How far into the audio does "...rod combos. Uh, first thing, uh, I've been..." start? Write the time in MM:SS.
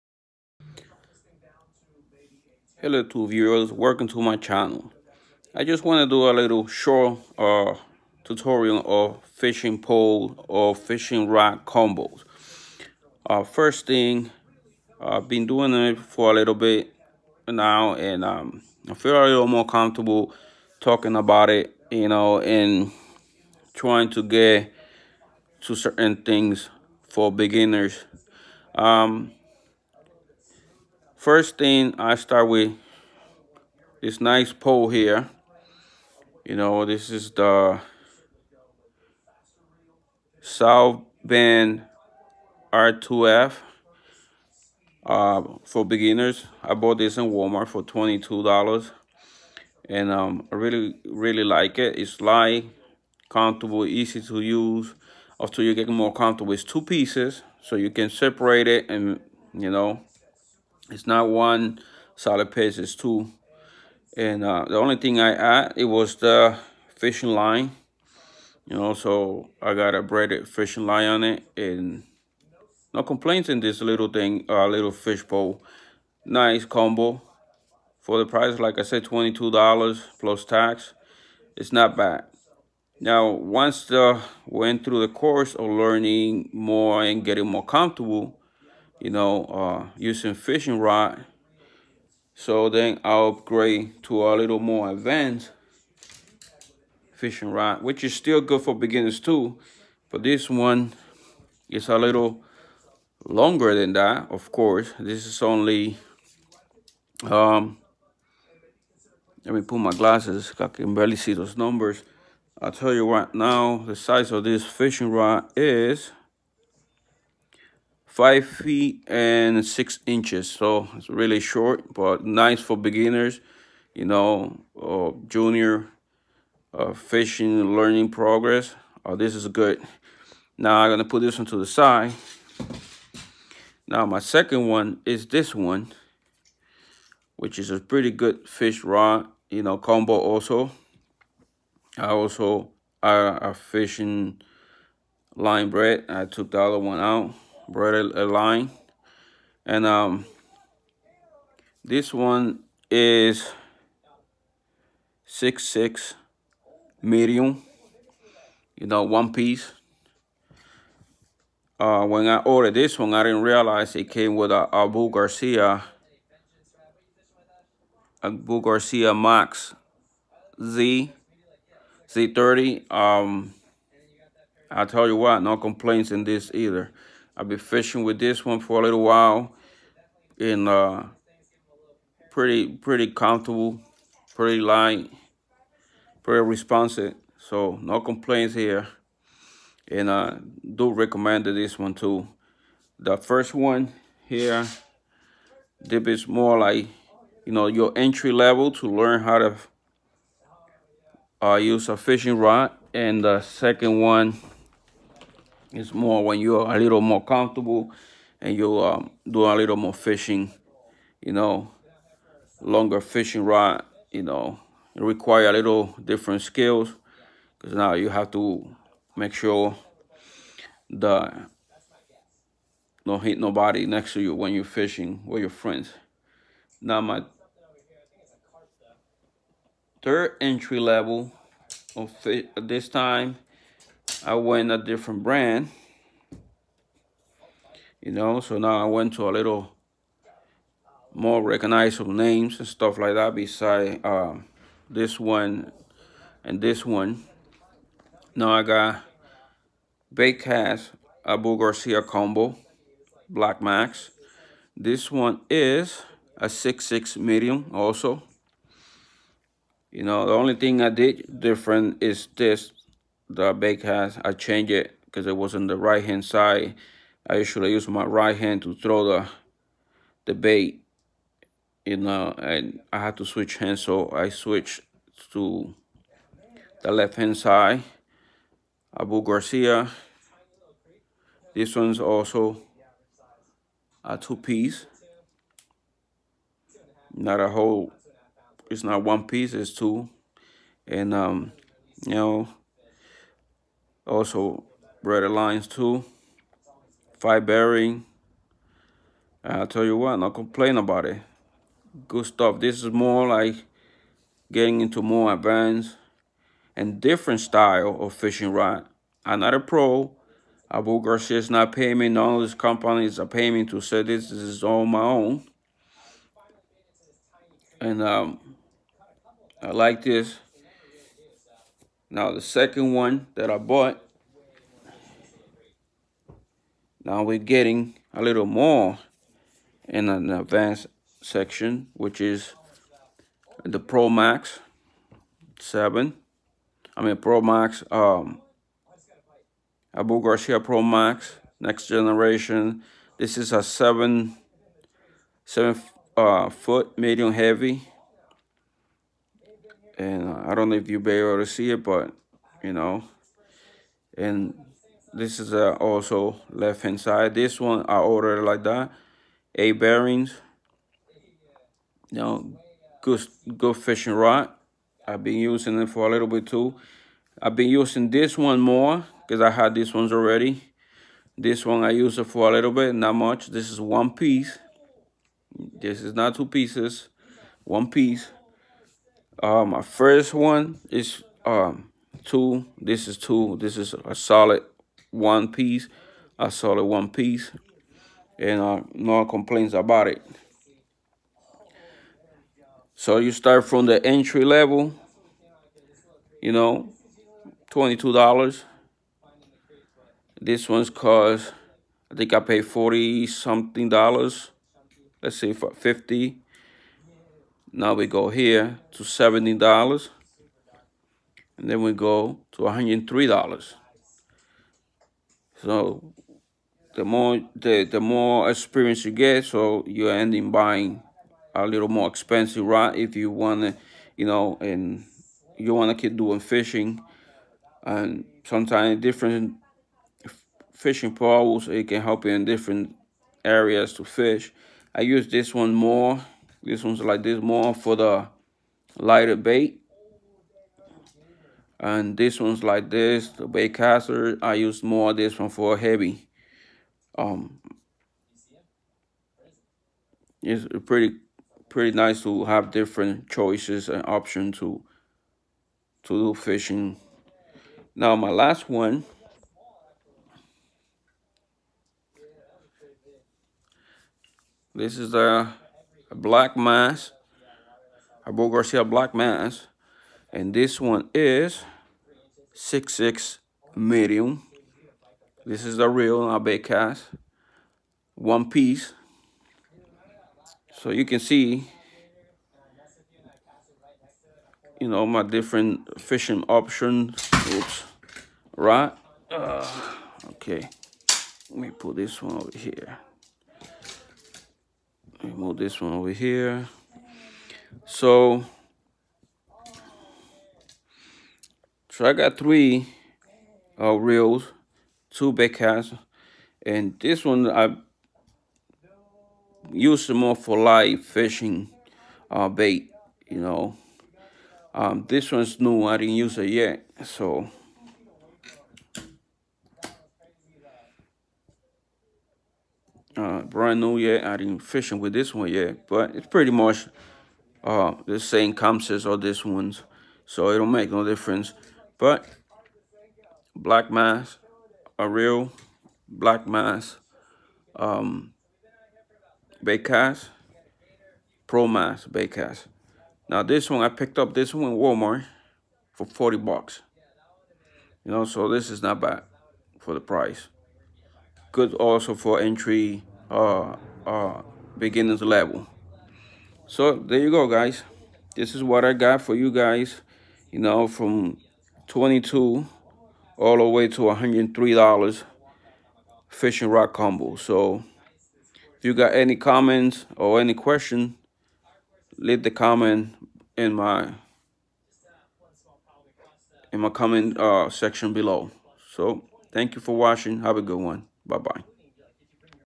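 00:11.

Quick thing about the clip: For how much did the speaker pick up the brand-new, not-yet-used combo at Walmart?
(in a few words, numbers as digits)
$40.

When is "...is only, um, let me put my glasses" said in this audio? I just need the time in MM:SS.
01:45.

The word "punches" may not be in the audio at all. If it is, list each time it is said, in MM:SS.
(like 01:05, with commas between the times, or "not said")
not said.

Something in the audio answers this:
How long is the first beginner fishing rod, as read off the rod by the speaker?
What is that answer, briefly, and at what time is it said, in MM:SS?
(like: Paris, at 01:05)
5 feet 6 inches, at 01:58.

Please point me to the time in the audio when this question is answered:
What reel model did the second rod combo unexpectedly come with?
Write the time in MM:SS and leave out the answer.
02:48.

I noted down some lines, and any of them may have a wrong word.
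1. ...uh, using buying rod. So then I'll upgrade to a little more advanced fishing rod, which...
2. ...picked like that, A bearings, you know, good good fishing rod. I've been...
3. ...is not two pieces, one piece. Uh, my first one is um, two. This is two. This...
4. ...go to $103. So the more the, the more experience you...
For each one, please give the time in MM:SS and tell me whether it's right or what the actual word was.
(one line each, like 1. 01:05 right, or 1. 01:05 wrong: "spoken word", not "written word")
1. 01:29 wrong: "fishing", not "buying"
2. 05:57 wrong: "ordered", not "picked"
3. 06:16 right
4. 06:51 right.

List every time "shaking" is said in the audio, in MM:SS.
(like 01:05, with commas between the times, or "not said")
not said.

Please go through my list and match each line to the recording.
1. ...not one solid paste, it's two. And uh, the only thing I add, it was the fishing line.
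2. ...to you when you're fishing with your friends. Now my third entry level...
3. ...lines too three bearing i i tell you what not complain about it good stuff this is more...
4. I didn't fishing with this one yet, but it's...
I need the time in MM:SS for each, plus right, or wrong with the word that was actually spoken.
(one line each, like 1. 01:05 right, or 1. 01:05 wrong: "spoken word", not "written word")
1. 01:01 right
2. 03:44 right
3. 04:55 wrong: "five", not "three"
4. 08:44 right.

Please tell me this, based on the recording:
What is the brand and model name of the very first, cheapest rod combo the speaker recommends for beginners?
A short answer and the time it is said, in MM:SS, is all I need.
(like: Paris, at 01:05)
South Bend R2F, at 00:40.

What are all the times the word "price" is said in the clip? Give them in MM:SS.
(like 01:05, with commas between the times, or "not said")
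01:18, 09:10.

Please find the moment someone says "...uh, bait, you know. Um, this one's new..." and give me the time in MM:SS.
08:32.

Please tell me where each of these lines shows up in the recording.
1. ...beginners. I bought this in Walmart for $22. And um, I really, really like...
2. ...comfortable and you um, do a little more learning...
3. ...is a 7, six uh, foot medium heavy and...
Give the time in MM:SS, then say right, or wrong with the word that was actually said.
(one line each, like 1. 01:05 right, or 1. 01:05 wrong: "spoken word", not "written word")
1. 00:45 right
2. 03:27 wrong: "fishing", not "learning"
3. 05:43 wrong: "seven", not "six".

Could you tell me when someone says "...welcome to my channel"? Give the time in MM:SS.
00:03.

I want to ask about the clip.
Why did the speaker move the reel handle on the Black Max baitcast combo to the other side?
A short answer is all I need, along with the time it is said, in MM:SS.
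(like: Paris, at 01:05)
It was on the right, at 04:25.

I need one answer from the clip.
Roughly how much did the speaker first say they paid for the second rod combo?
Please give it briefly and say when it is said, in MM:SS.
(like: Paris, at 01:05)
40 something dollars, at 06:42.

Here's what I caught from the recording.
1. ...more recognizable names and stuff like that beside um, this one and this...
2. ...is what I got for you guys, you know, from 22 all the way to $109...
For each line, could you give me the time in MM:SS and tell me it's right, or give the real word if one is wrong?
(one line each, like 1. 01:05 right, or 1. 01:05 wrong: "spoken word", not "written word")
1. 04:01 right
2. 09:18 wrong: "103", not "109".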